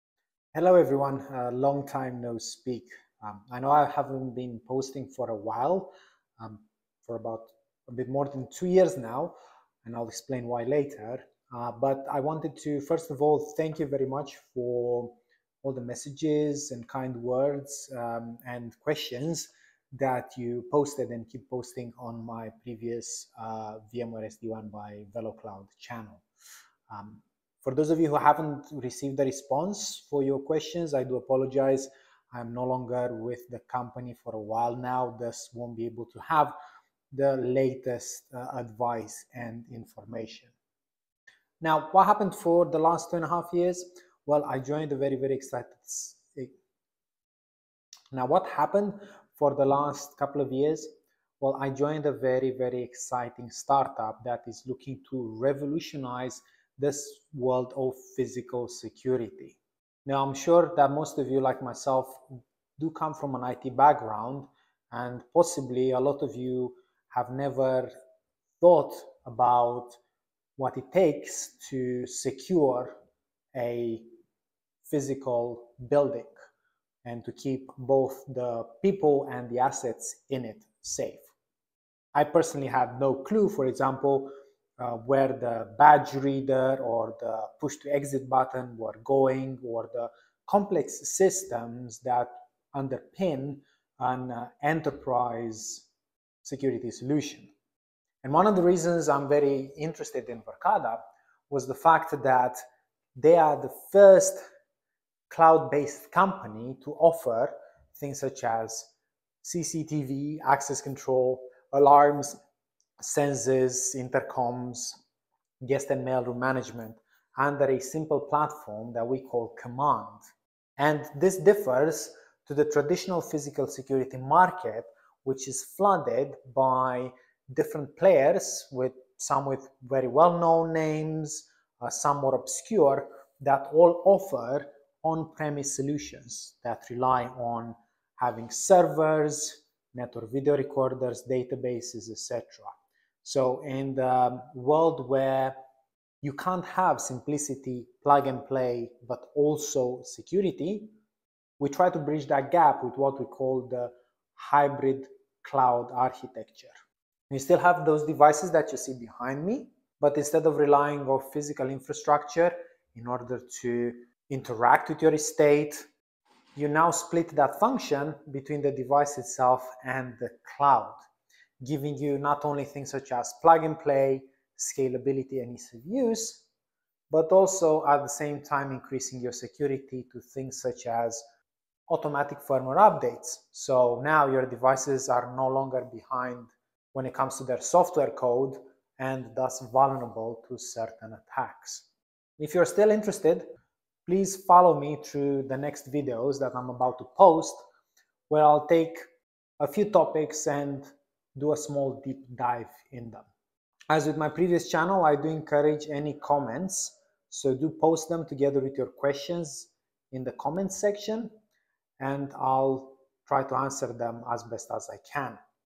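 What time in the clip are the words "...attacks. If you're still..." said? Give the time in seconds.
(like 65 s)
191 s.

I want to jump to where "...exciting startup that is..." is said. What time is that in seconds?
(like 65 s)
52 s.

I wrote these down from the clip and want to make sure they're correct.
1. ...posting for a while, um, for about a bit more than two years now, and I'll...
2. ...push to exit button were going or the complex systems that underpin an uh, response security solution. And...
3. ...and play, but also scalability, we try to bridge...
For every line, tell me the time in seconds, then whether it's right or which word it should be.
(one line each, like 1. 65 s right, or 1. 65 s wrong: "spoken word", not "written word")
1. 4 s right
2. 87 s wrong: "enterprise", not "response"
3. 148 s wrong: "security", not "scalability".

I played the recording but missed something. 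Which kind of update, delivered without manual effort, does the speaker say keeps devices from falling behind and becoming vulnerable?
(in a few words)
automatic firmware updates.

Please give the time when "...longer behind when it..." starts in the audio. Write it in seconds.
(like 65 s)
185 s.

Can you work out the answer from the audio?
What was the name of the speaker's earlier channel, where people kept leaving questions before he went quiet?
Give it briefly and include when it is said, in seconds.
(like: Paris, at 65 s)
VMware SD-WAN by VeloCloud, at 23 s.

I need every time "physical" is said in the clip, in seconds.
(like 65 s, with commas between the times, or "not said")
58 s, 74 s, 123 s, 161 s.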